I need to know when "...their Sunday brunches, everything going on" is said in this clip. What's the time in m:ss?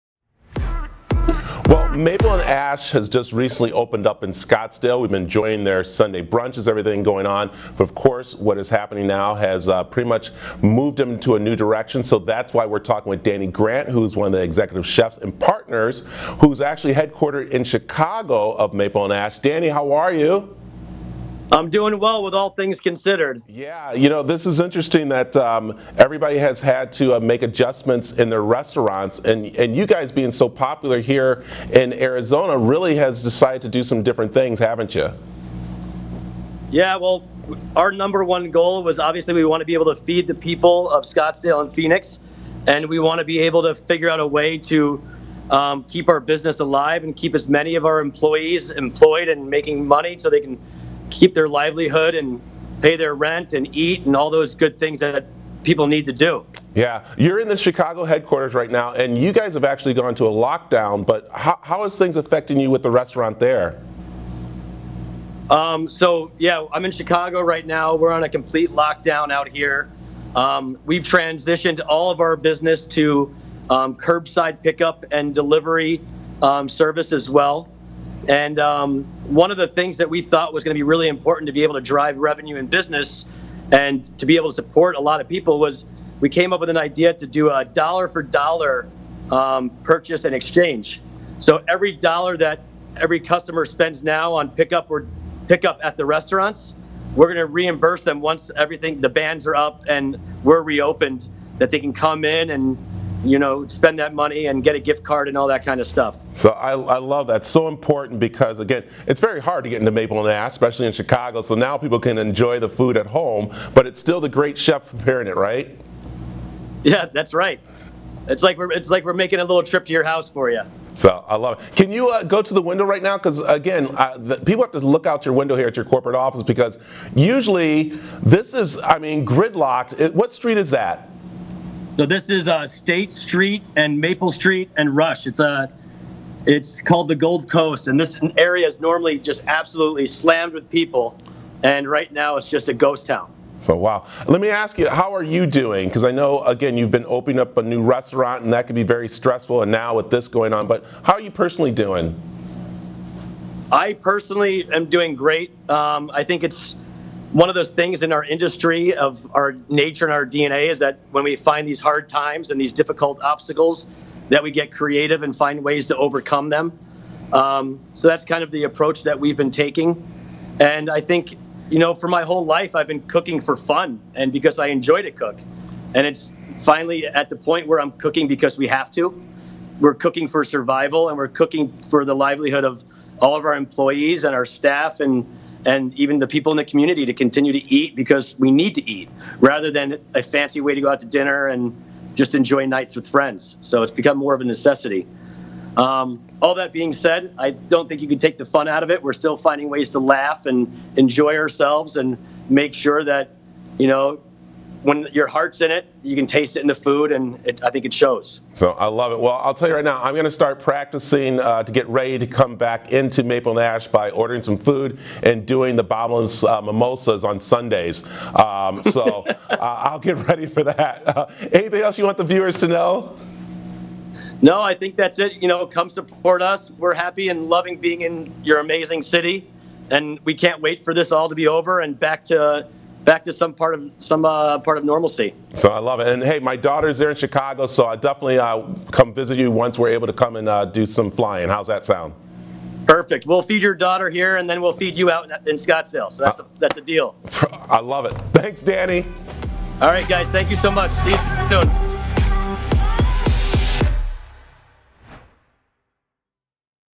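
0:05.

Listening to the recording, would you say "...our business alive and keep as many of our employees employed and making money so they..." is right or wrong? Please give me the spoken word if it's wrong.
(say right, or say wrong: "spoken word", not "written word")
right.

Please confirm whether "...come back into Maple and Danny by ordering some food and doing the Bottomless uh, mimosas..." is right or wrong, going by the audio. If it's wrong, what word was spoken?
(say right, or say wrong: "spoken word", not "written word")
wrong: "Ash", not "Danny".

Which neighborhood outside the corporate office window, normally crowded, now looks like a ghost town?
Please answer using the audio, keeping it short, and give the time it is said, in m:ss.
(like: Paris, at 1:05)
Gold Coast, at 2:17.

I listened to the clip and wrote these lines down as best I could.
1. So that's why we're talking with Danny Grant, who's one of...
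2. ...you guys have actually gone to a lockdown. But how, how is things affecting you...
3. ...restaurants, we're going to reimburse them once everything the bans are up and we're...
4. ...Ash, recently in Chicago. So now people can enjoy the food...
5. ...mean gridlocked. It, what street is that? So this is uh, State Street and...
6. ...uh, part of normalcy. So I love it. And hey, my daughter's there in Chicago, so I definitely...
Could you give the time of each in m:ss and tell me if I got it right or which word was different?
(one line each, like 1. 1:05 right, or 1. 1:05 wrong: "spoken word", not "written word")
1. 0:12 right
2. 0:59 right
3. 1:36 right
4. 1:50 wrong: "especially", not "recently"
5. 2:08 right
6. 3:54 right.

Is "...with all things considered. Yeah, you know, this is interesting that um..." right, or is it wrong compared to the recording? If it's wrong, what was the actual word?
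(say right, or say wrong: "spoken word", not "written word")
right.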